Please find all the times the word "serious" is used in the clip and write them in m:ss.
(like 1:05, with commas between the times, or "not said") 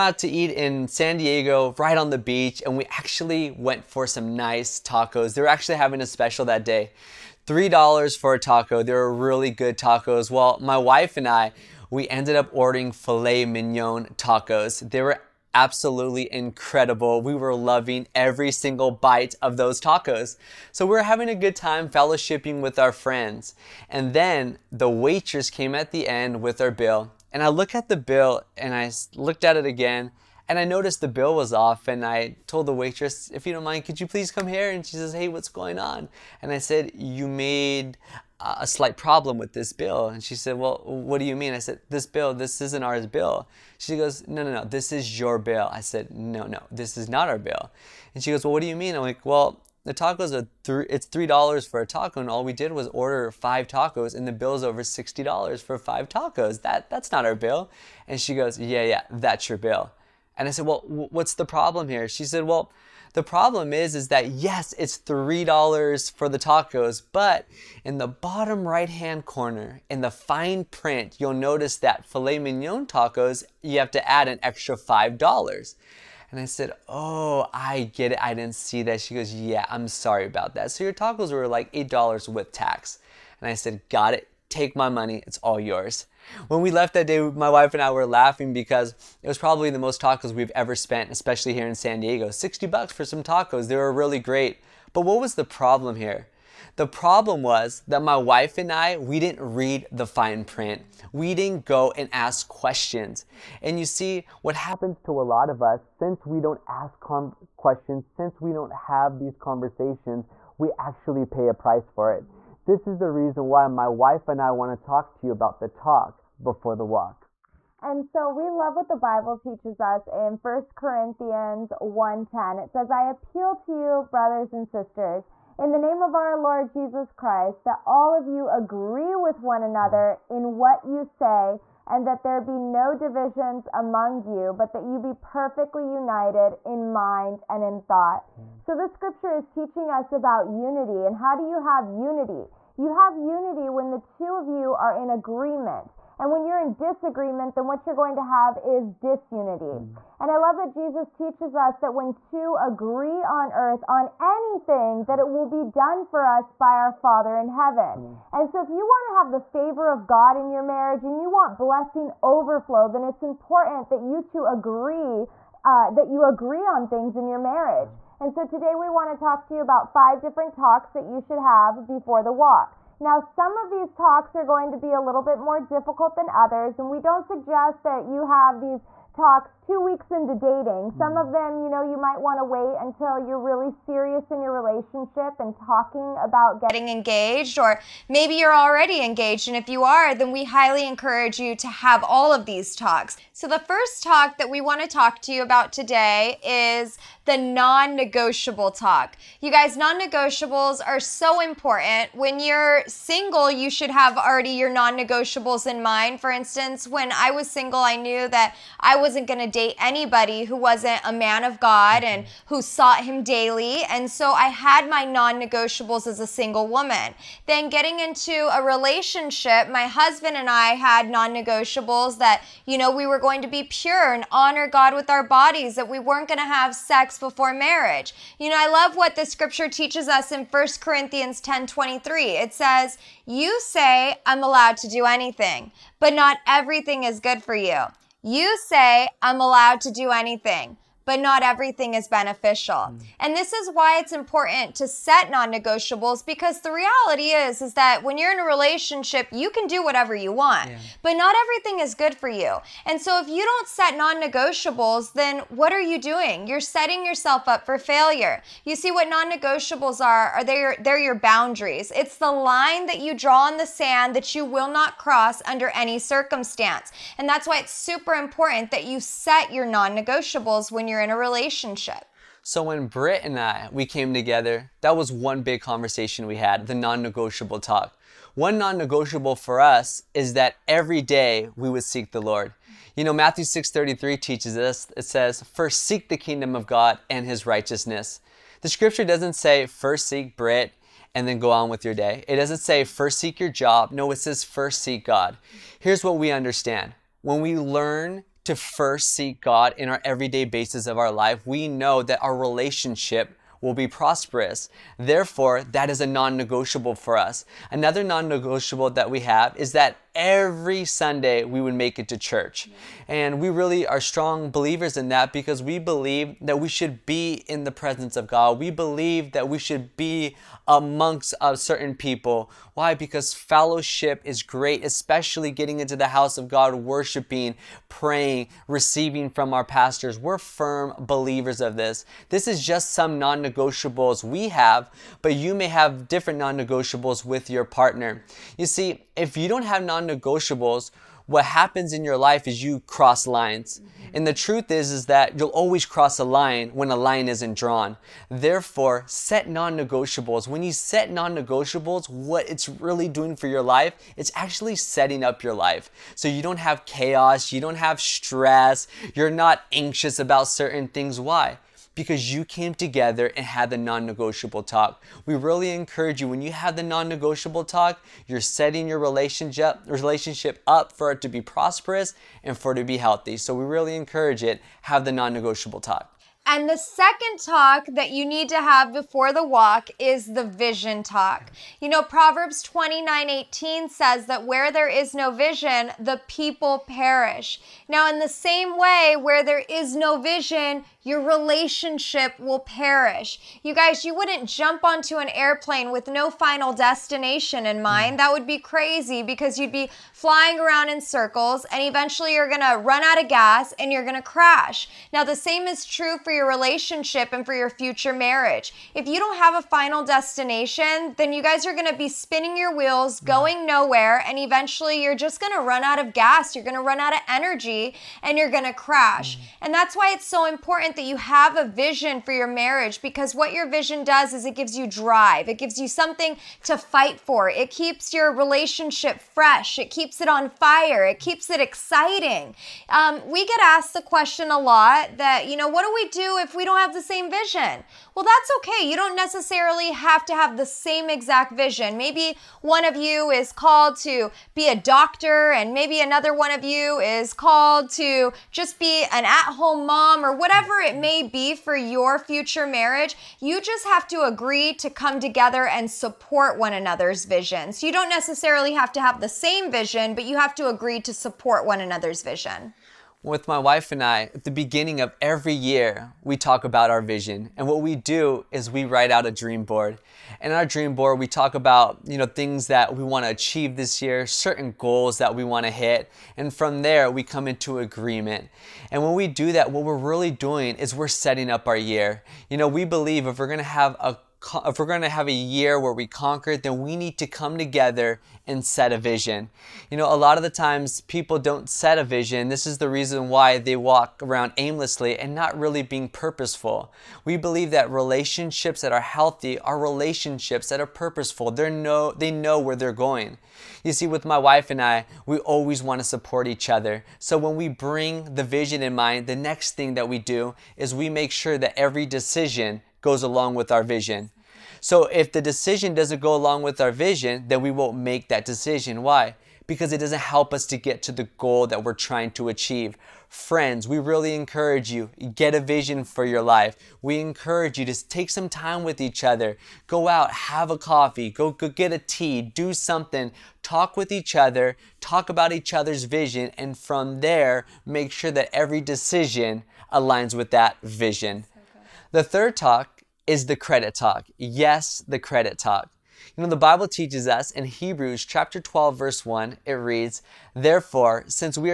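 3:03.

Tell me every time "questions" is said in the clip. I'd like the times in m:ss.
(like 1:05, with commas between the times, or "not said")
1:42, 1:47, 7:14.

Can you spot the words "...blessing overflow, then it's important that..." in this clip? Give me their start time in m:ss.
2:41.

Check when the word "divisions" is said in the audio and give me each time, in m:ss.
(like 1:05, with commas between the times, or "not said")
2:12.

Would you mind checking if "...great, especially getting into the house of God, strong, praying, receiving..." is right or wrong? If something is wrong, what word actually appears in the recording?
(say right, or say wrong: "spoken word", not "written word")
wrong: "worshiping", not "strong".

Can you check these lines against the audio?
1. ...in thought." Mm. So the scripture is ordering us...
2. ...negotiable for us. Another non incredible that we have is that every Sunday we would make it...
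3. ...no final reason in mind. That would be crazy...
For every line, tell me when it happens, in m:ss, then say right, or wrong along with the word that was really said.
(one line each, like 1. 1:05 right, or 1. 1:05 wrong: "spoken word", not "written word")
1. 2:17 wrong: "teaching", not "ordering"
2. 5:06 wrong: "negotiable", not "incredible"
3. 6:36 wrong: "destination", not "reason".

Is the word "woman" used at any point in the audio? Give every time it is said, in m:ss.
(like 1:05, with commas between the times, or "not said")
3:36.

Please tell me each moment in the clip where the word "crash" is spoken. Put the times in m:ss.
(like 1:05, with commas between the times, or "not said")
6:44, 6:58.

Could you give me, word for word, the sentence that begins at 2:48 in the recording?
And so today we want to talk to you about five different talks that you should have before the walk.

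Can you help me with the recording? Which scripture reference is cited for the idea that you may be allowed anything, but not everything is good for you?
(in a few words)
1 Corinthians 10:23.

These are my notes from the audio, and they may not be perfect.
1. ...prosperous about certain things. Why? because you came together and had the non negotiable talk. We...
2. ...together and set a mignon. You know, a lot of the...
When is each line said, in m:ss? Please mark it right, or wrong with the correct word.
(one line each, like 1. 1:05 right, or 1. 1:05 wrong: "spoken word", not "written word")
1. 5:59 wrong: "anxious", not "prosperous"
2. 8:07 wrong: "vision", not "mignon".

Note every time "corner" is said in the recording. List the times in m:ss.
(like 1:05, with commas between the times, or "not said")
1:09.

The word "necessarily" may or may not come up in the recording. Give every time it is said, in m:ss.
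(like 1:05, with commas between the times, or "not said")
7:19, 7:38.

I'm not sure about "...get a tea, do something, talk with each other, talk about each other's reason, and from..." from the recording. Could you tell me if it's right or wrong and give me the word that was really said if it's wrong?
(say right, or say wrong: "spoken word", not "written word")
wrong: "vision", not "reason".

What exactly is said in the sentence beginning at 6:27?
Now, in the same way, where there is no vision, your relationship will perish.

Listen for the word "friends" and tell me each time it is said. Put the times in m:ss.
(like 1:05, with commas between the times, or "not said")
0:22, 8:43.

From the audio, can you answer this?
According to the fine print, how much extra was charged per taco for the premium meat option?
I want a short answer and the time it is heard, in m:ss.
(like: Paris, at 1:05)
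$5, at 1:14.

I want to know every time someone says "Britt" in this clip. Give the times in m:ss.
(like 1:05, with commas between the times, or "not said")
4:32, 4:50.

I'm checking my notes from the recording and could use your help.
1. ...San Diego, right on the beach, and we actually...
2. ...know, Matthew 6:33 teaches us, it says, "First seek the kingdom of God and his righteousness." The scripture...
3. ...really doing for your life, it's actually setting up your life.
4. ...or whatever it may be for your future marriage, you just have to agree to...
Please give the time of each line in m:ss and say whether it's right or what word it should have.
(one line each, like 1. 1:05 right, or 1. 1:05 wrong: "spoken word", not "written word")
1. 0:00 right
2. 4:43 right
3. 5:52 right
4. 7:30 right.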